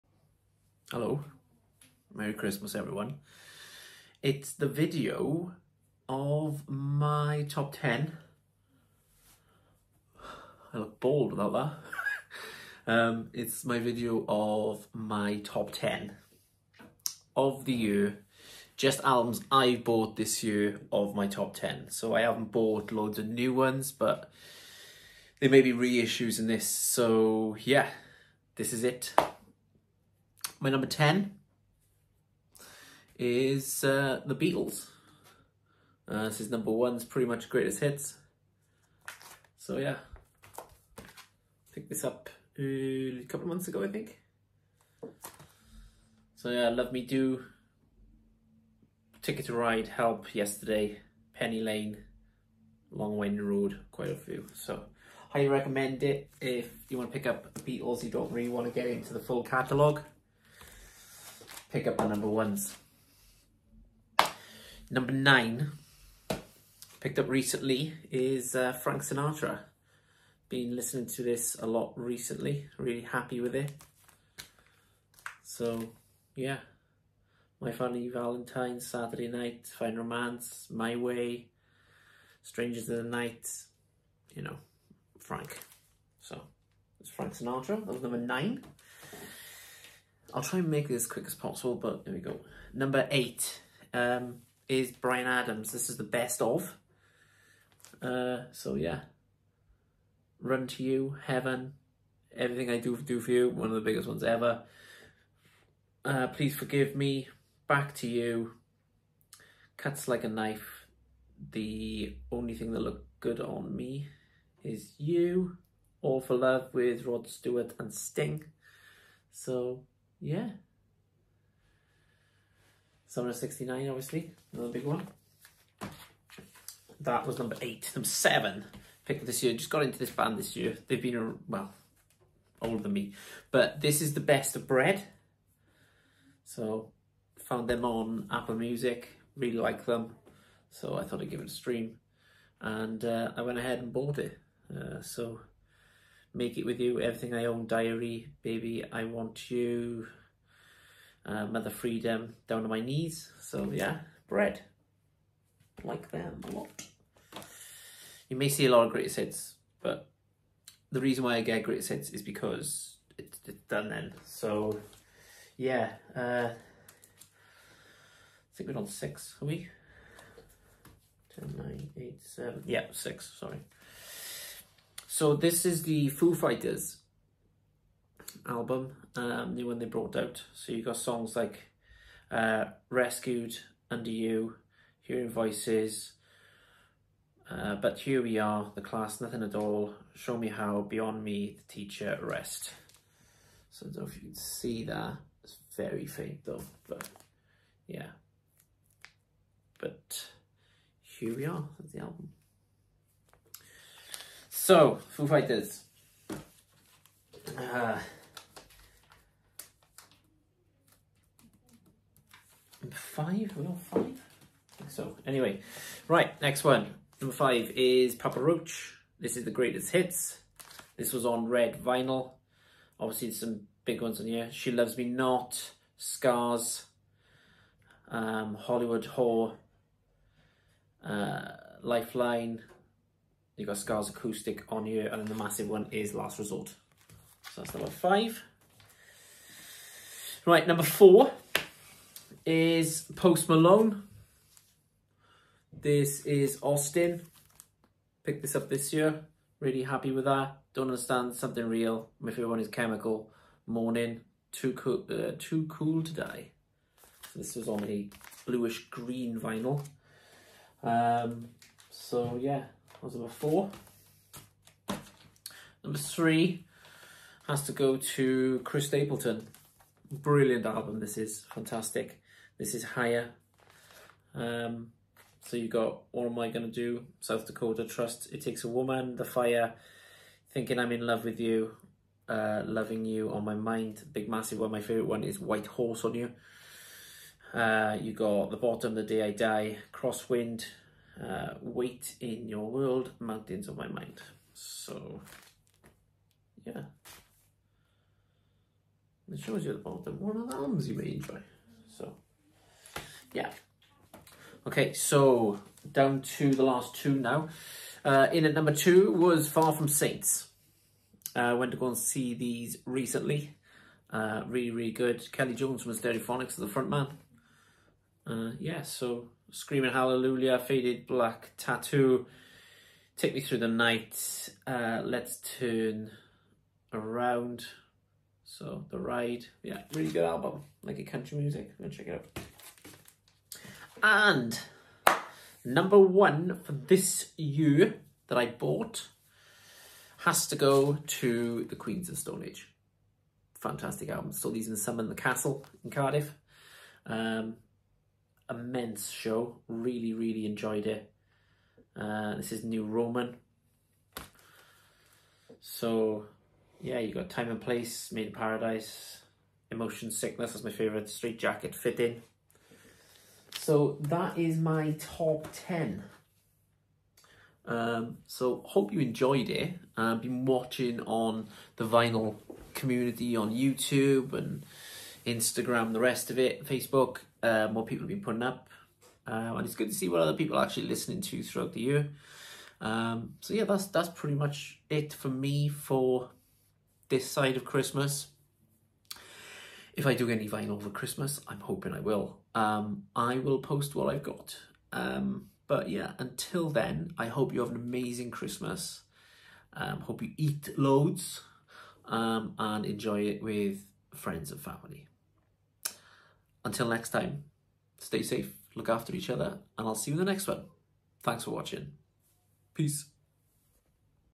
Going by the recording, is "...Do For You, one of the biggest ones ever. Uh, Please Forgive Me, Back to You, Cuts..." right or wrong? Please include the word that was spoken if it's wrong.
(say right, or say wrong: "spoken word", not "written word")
right.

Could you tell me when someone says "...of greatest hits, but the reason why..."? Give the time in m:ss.
2:38.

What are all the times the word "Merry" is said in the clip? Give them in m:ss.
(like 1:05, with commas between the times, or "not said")
0:02.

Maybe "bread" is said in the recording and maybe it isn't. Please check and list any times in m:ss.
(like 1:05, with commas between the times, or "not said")
2:14, 2:34.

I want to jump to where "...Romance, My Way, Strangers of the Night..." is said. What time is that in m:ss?
1:19.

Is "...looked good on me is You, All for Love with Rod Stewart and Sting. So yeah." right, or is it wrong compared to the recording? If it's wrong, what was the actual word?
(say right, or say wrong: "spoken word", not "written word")
right.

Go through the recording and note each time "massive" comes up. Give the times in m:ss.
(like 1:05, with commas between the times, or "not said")
3:55, 4:44.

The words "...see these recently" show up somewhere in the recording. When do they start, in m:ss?
5:11.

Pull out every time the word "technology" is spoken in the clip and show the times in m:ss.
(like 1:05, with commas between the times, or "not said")
not said.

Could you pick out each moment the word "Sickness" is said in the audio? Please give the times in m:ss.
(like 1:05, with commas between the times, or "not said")
6:00.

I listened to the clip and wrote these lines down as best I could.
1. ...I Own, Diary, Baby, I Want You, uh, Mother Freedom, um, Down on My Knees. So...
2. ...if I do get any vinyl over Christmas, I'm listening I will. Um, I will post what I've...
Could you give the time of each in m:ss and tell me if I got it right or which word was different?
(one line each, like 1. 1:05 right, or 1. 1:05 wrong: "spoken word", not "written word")
1. 2:27 right
2. 6:30 wrong: "hoping", not "listening".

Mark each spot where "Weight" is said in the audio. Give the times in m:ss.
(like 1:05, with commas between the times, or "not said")
4:51.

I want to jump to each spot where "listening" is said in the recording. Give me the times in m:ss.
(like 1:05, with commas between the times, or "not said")
1:10, 6:20.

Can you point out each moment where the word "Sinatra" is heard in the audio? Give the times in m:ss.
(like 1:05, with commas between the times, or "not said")
1:09, 1:27.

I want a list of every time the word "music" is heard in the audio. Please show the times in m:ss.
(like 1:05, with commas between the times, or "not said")
2:18, 5:31.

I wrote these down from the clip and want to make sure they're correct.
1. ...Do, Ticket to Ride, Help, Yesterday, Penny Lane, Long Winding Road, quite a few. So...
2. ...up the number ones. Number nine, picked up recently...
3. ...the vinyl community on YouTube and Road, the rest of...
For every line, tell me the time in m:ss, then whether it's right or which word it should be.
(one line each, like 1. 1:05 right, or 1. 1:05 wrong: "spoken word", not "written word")
1. 0:47 right
2. 1:01 right
3. 6:11 wrong: "Instagram", not "Road".